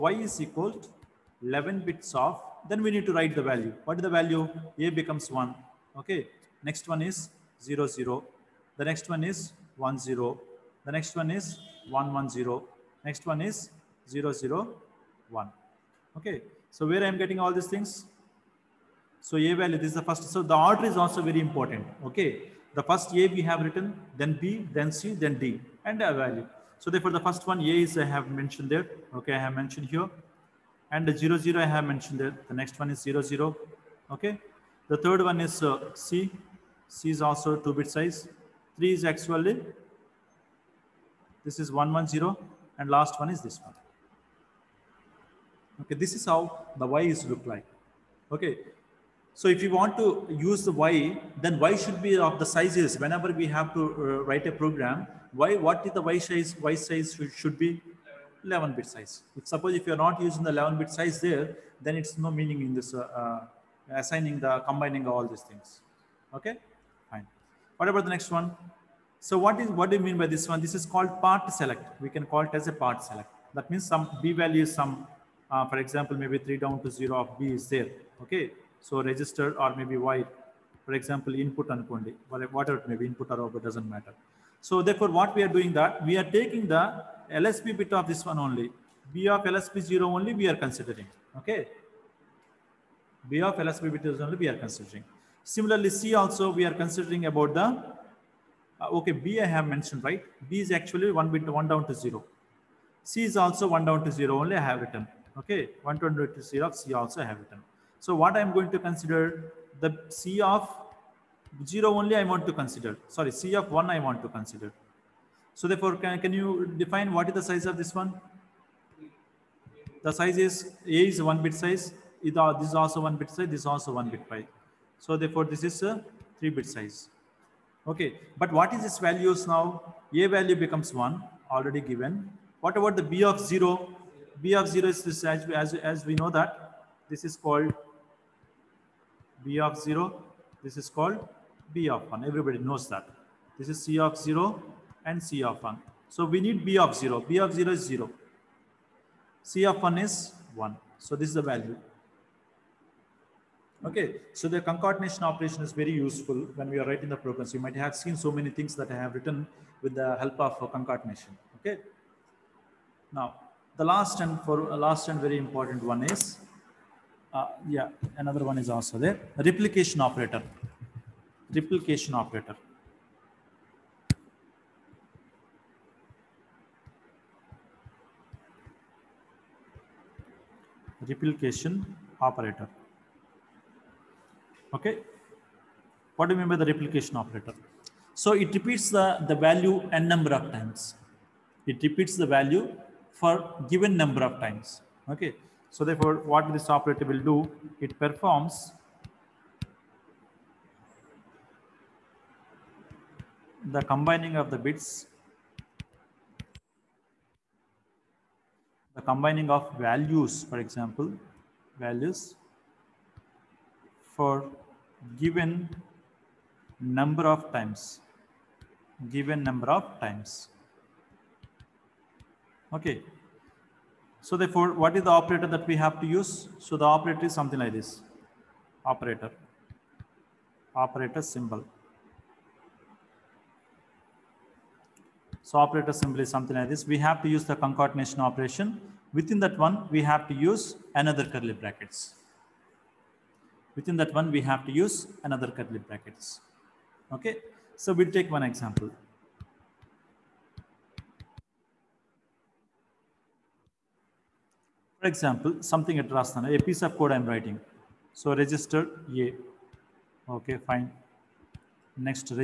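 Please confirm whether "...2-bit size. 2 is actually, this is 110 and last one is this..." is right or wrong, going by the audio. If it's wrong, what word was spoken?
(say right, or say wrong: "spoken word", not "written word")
wrong: "3", not "2".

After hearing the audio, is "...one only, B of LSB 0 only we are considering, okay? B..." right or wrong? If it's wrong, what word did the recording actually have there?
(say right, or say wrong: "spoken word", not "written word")
right.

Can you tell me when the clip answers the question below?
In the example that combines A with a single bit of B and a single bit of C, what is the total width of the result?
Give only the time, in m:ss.
2:06.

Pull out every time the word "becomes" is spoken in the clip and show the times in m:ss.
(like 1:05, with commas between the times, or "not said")
0:04, 2:10.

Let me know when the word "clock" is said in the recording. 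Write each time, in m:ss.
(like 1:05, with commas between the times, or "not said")
not said.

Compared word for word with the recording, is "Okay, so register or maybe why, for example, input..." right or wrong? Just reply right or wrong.
right.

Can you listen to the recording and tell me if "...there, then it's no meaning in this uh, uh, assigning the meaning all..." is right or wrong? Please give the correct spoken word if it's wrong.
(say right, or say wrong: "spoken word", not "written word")
wrong: "combining", not "meaning".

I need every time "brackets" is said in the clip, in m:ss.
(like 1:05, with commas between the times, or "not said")
4:01, 4:05.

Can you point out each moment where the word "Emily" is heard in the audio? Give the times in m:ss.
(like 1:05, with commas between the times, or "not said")
not said.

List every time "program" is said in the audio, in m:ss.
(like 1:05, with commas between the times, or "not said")
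0:54, 2:37.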